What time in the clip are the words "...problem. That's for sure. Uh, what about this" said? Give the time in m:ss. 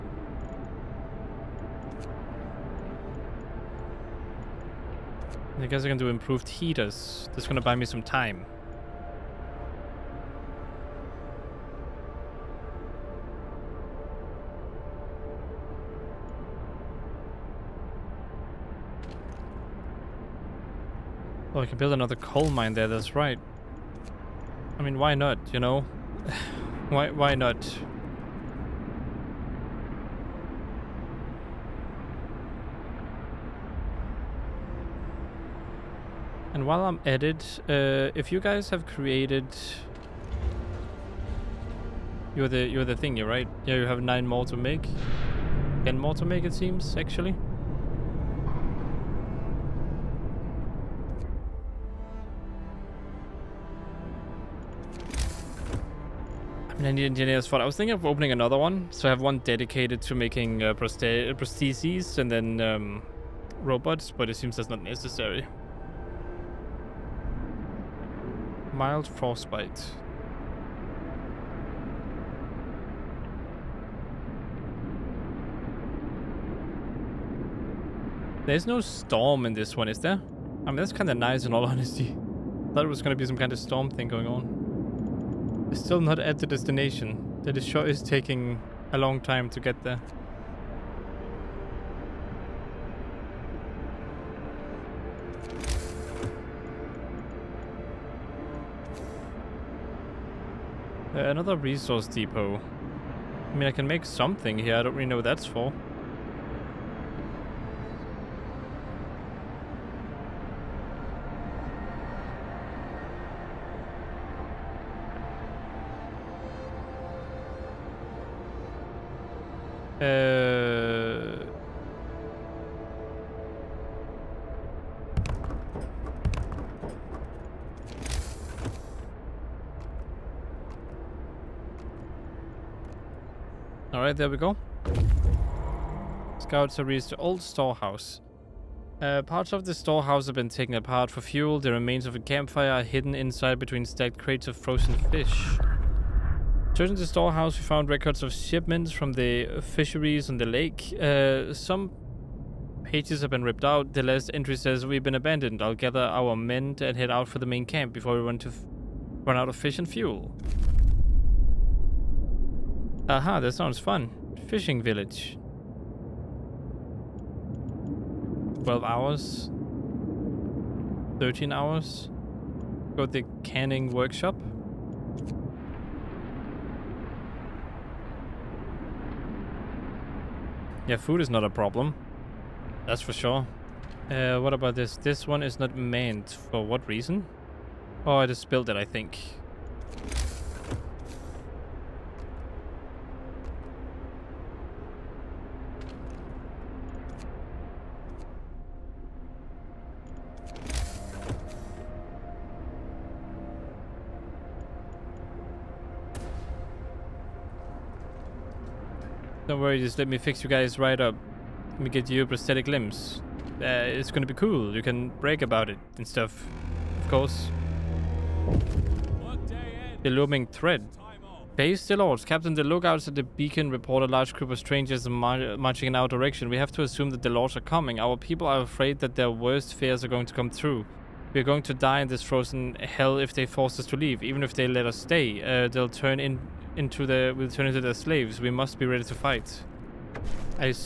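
3:01.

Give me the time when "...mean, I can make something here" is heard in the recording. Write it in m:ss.
1:43.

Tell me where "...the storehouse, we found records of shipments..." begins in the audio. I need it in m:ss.
2:26.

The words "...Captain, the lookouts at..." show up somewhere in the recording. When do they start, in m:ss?
3:42.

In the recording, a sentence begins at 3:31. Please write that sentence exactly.
Let me get you prosthetic limbs.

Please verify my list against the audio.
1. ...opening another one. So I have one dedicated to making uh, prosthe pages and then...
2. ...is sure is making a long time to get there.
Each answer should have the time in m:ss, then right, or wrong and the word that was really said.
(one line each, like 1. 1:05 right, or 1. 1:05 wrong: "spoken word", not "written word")
1. 0:58 wrong: "prostheses", not "pages"
2. 1:27 wrong: "taking", not "making".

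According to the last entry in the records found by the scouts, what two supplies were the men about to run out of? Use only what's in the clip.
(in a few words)
Fish and fuel.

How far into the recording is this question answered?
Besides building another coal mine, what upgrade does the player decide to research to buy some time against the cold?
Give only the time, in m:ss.
0:06.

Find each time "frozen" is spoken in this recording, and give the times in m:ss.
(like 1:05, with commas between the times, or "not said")
2:24, 3:52.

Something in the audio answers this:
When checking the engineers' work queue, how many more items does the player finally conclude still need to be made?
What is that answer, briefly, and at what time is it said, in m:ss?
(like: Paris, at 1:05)
10, at 0:45.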